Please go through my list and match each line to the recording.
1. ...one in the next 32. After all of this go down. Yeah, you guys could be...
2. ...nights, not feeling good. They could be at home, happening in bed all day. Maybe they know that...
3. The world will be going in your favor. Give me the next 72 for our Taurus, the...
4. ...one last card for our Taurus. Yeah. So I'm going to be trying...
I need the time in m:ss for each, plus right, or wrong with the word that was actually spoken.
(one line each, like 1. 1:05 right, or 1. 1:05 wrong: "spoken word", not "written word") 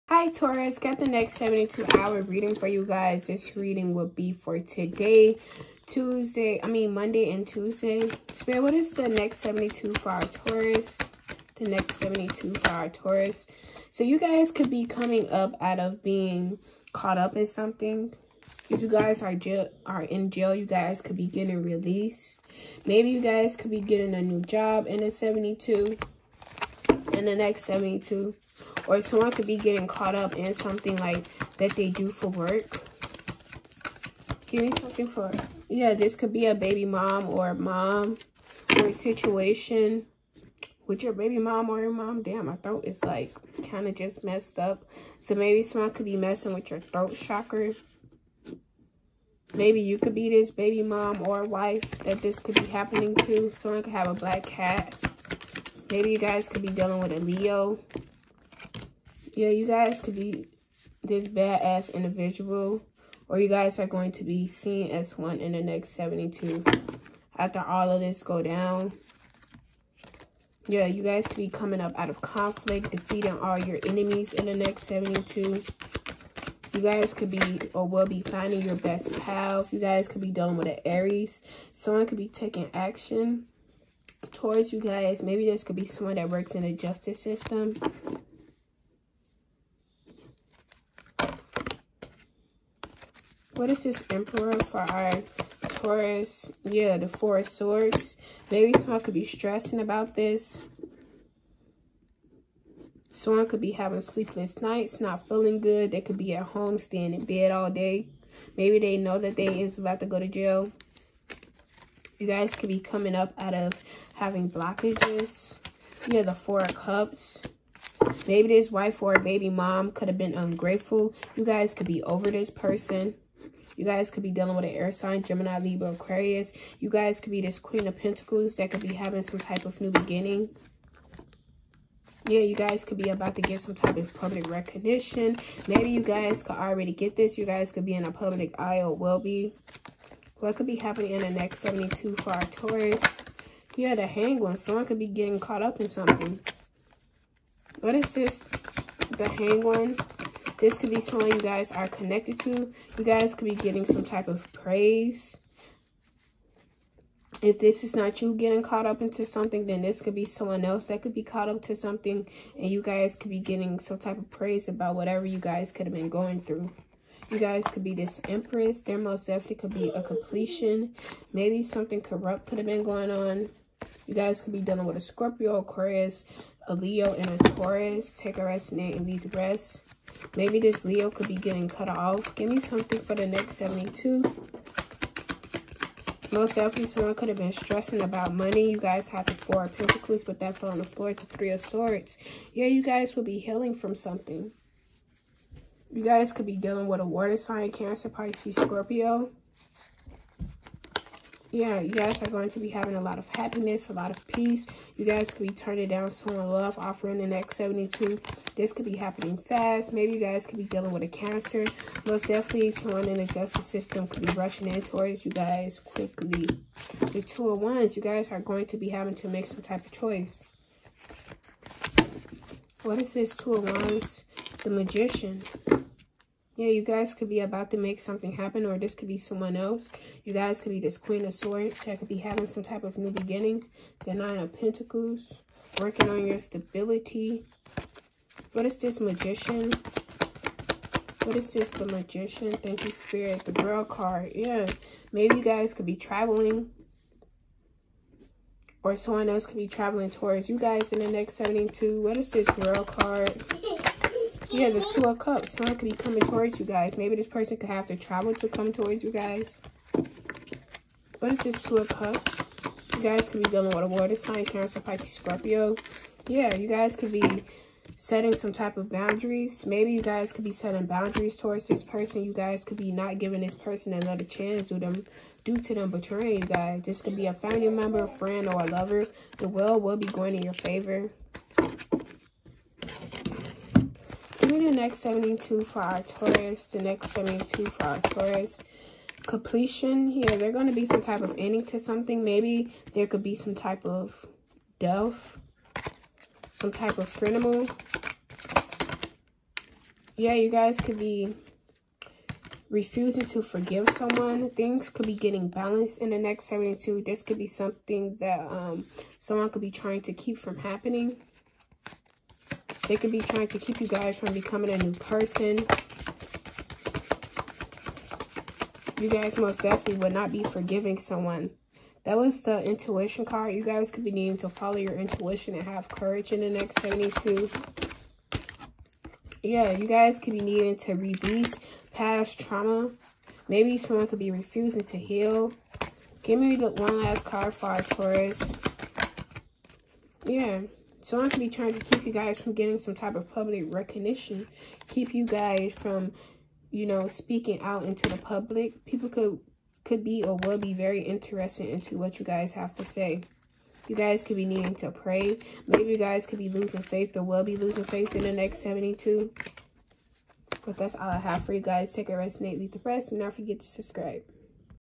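1. 1:05 wrong: "72", not "32"
2. 1:44 wrong: "staying", not "happening"
3. 4:39 right
4. 5:36 right.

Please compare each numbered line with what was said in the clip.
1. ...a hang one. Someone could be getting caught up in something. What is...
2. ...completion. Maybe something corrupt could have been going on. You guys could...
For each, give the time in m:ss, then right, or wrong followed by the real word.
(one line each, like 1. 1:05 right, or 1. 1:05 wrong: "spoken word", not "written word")
1. 2:23 right
2. 2:50 right.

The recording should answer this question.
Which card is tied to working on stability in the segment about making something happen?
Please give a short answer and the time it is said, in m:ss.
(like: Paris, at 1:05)
Nine of Pentacles, at 3:54.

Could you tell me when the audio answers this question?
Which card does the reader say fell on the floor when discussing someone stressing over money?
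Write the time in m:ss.
3:11.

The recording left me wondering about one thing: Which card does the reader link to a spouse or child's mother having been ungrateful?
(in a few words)
Four of Cups.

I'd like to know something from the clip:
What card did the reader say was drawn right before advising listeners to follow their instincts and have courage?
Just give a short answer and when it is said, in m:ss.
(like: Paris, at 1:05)
intuition card, at 5:22.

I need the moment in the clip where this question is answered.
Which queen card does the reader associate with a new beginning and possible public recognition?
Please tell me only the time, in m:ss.
2:07.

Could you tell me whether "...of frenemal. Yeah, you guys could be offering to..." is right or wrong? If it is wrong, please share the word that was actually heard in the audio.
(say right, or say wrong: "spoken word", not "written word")
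wrong: "refusing", not "offering".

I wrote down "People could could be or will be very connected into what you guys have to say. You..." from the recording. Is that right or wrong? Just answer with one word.
wrong.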